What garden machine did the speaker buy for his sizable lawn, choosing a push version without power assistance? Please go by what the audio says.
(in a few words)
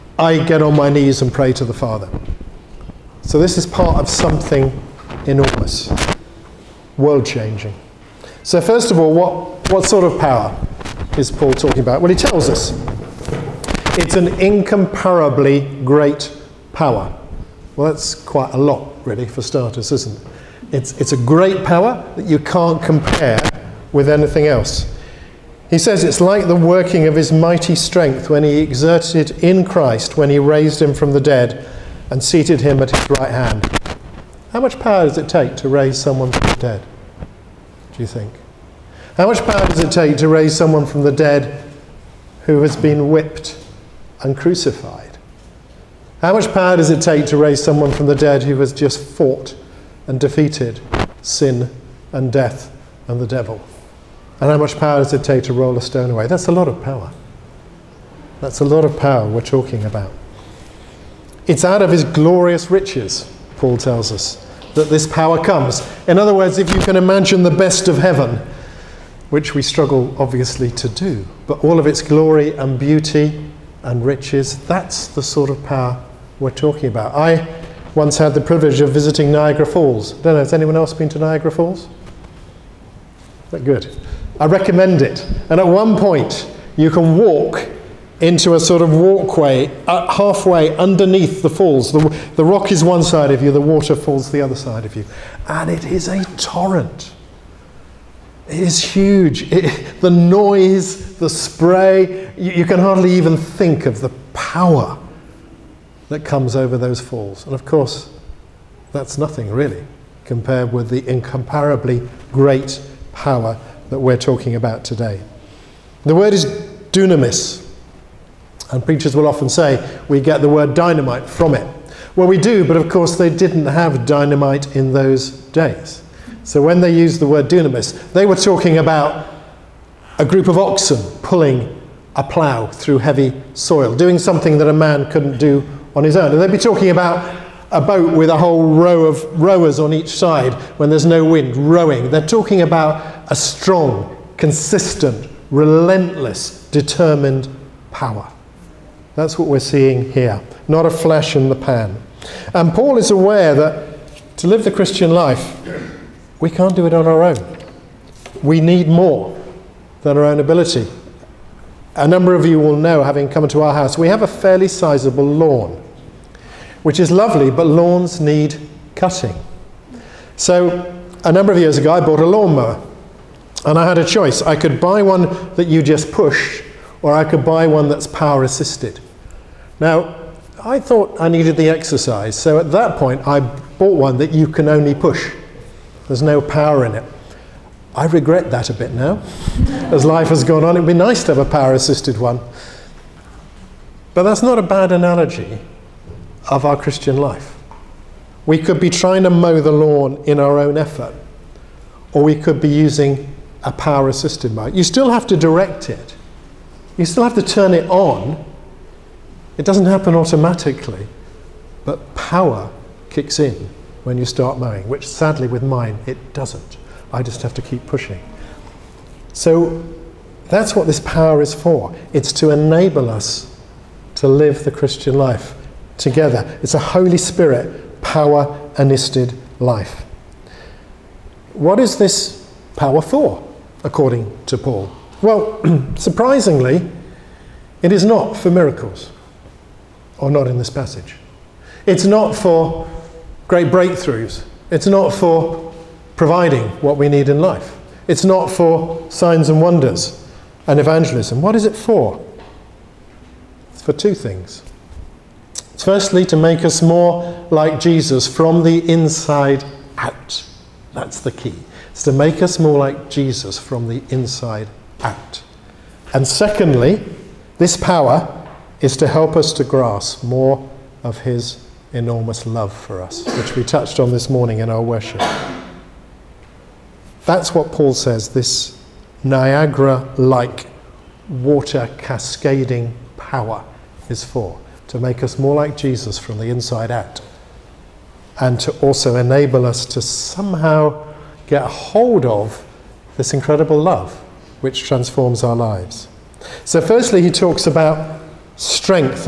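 lawnmower.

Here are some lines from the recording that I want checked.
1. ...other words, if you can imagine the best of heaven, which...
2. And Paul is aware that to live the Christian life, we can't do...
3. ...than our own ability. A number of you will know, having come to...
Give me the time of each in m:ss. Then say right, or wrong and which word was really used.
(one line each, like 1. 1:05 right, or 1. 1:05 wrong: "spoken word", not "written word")
1. 1:06 right
2. 2:32 right
3. 2:40 right.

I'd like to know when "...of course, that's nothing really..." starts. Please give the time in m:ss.
1:47.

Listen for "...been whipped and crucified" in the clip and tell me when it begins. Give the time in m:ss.
0:42.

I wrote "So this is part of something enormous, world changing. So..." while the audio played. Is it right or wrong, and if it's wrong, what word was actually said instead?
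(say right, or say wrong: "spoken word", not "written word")
right.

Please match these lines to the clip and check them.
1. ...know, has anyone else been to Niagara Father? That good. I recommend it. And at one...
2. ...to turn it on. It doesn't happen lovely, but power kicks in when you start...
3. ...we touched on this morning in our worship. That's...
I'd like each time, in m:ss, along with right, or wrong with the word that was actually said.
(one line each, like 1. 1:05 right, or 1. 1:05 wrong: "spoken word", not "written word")
1. 1:20 wrong: "Falls", not "Father"
2. 3:27 wrong: "automatically", not "lovely"
3. 4:33 right.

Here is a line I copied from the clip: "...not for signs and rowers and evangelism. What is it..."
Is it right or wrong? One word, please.
wrong.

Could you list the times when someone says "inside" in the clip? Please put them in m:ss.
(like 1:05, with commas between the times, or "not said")
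4:18, 4:24, 4:46.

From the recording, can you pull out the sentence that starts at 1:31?
The, the rock is one side of you, the water falls the other side of you.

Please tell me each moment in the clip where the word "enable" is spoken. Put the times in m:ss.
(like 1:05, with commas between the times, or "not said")
3:42, 4:49.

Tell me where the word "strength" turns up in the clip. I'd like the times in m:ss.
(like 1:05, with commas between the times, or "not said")
0:27, 4:58.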